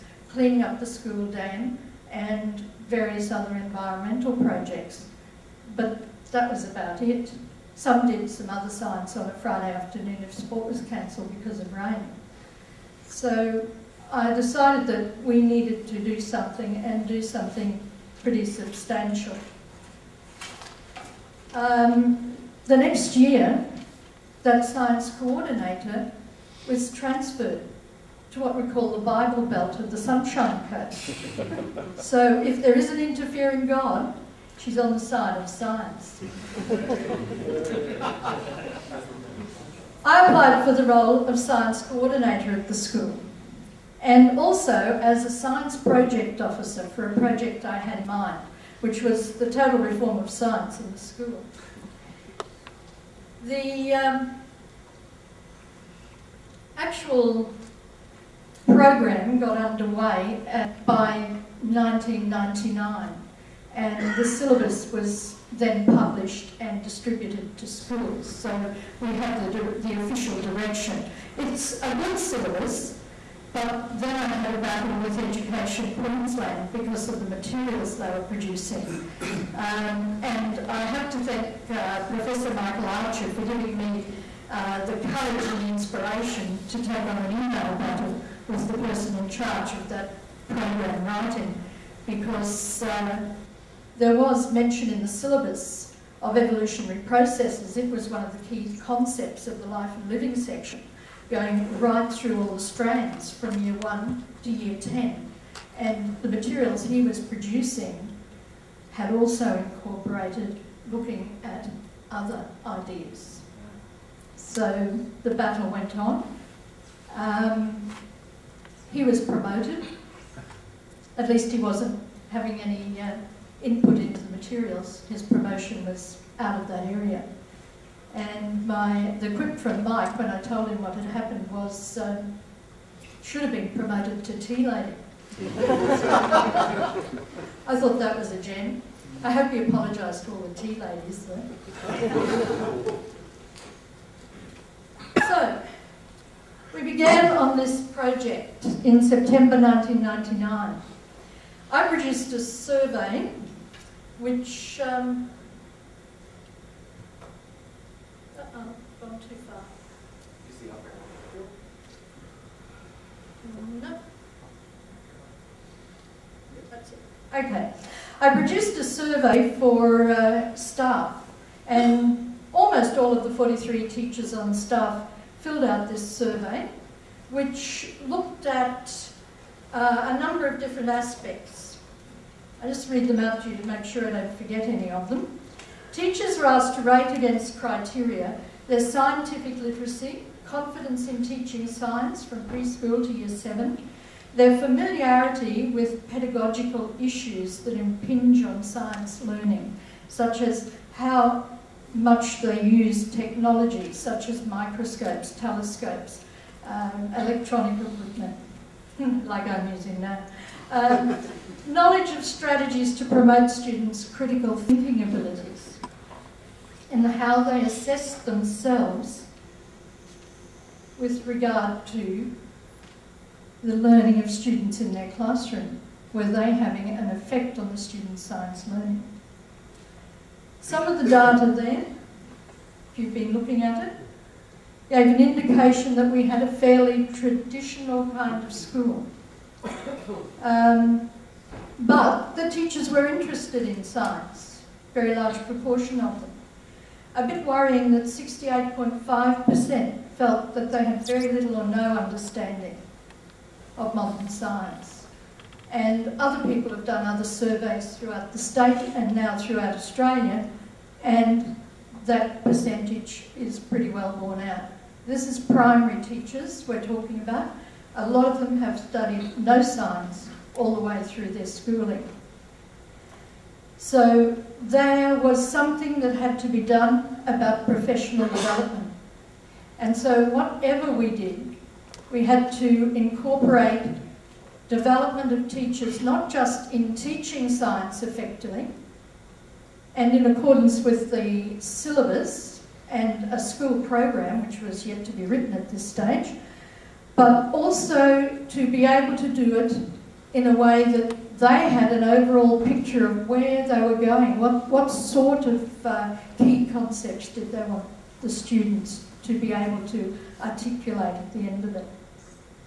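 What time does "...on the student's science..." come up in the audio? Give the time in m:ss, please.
3:47.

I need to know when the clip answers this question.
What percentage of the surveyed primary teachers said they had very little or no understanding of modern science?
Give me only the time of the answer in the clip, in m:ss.
4:08.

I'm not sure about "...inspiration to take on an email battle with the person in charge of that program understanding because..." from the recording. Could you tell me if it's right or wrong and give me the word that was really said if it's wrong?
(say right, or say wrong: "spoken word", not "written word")
wrong: "writing", not "understanding".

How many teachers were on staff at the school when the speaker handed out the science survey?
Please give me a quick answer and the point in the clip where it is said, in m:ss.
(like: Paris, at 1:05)
43, at 2:53.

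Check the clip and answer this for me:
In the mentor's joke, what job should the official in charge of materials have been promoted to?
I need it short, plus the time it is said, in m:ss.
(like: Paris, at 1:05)
tea lady, at 2:14.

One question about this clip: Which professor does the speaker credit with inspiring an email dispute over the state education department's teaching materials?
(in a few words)
Michael Archer.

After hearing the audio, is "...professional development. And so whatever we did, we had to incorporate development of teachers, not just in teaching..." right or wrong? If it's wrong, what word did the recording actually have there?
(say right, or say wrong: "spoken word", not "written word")
right.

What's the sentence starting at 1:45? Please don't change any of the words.
And the materials he was producing had also incorporated looking at other ideas.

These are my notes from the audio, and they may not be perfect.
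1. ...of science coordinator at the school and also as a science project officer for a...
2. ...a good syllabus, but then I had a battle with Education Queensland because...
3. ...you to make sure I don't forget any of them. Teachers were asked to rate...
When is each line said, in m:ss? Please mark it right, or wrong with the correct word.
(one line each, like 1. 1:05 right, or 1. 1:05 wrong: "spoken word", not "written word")
1. 0:41 right
2. 1:11 right
3. 3:03 right.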